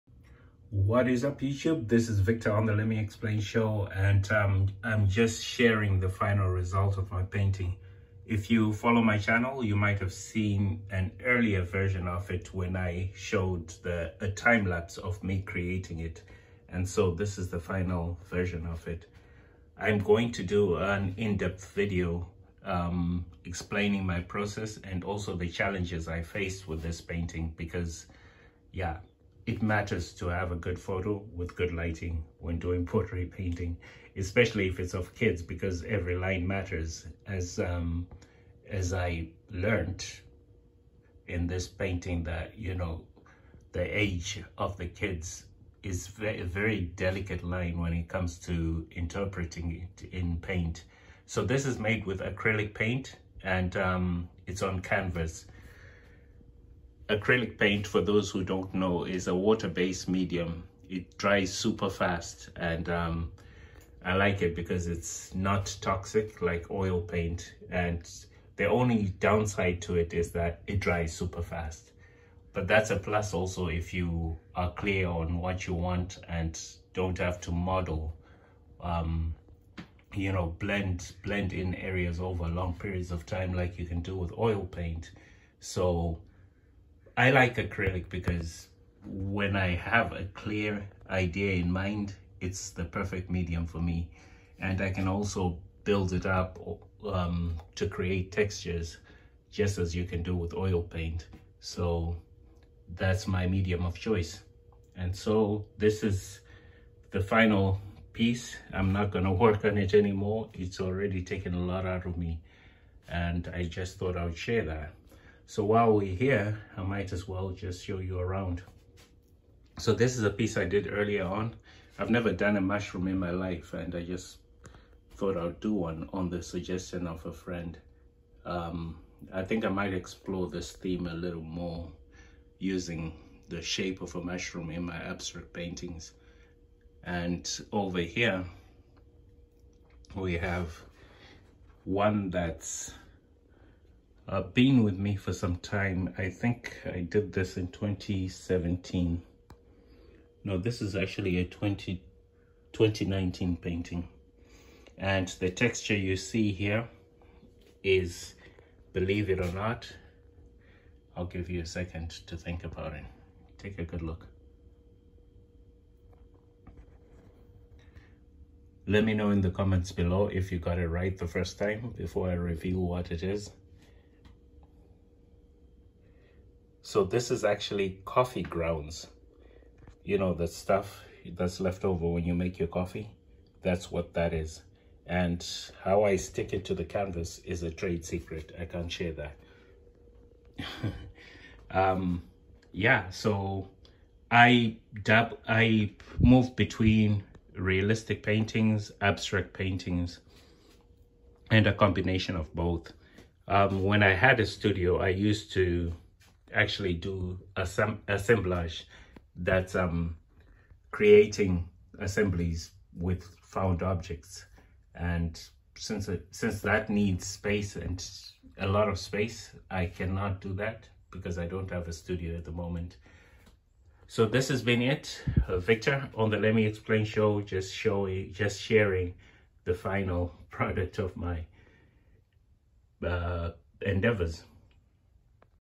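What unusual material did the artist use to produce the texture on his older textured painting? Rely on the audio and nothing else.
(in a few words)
Coffee grounds.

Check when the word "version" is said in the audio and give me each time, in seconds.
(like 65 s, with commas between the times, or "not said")
11 s, 18 s.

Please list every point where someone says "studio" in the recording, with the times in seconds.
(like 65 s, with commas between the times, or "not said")
204 s, 221 s.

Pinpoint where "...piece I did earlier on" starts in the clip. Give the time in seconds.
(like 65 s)
120 s.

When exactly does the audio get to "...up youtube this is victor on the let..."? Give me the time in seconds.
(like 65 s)
1 s.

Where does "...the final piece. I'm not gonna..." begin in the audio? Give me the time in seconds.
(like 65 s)
107 s.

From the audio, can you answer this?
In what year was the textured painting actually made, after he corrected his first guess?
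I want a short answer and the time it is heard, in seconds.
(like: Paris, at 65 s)
2019, at 152 s.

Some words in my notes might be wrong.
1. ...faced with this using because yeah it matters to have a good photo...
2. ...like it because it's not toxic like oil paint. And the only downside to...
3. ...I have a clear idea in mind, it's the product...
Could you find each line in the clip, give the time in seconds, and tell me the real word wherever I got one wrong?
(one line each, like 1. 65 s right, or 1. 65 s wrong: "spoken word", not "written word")
1. 26 s wrong: "painting", not "using"
2. 64 s right
3. 89 s wrong: "perfect", not "product".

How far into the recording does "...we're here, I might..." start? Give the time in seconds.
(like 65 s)
115 s.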